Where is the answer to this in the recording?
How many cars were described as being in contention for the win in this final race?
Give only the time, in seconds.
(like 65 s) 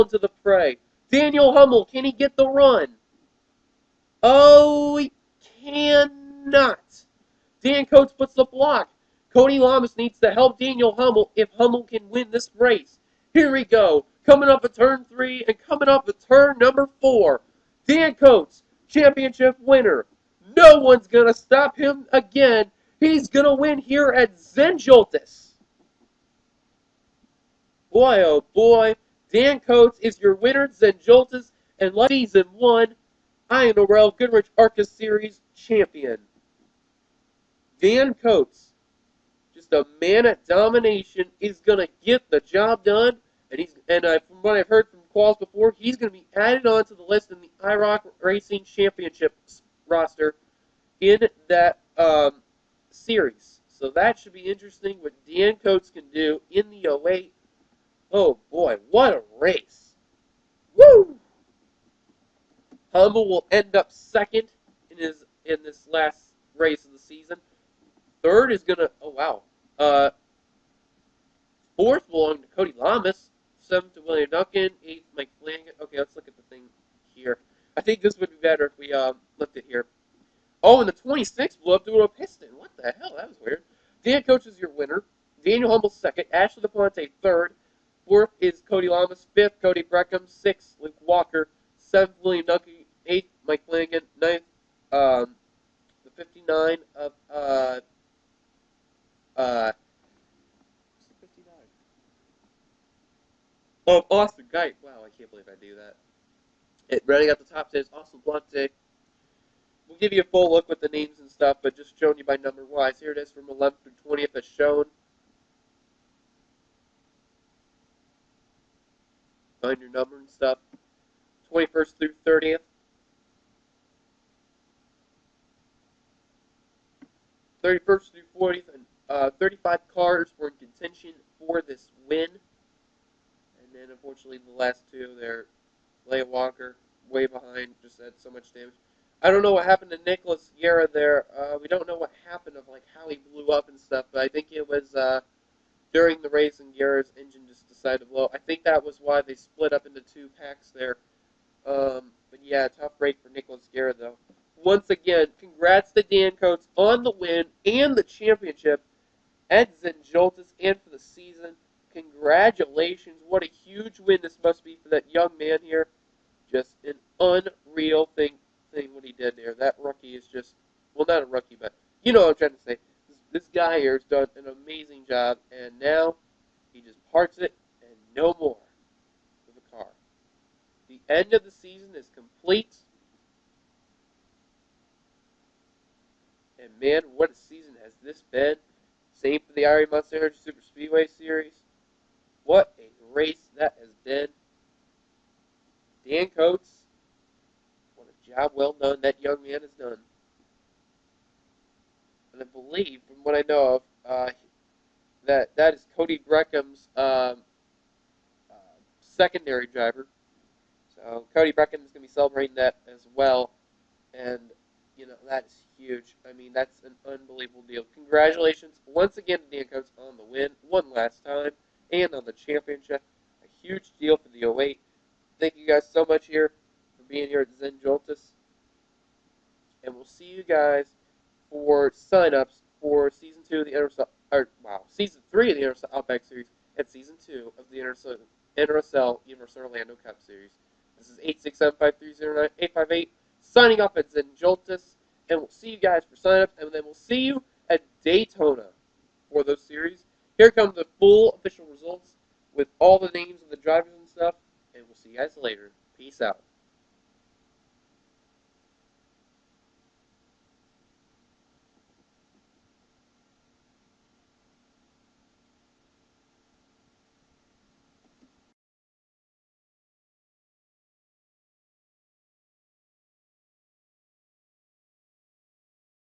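129 s.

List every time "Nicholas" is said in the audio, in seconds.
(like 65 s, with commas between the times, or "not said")
140 s, 153 s.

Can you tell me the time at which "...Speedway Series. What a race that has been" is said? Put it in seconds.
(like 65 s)
190 s.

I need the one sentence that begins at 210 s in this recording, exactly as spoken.
So Cody Breckham is going to be celebrating that as well.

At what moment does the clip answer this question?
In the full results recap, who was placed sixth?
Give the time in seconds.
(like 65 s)
90 s.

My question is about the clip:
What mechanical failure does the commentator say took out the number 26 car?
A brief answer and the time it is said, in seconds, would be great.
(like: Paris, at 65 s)
a piston, at 81 s.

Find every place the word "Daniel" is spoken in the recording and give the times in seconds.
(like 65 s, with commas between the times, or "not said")
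1 s, 10 s, 85 s.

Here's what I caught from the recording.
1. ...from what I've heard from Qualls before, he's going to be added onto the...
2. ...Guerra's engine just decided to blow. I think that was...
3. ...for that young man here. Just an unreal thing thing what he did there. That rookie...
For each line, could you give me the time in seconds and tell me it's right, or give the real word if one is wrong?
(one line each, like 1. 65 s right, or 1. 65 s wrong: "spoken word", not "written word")
1. 44 s right
2. 146 s right
3. 164 s right.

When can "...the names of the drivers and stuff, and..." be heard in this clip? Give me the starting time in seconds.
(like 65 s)
252 s.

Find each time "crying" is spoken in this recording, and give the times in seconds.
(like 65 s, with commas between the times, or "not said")
not said.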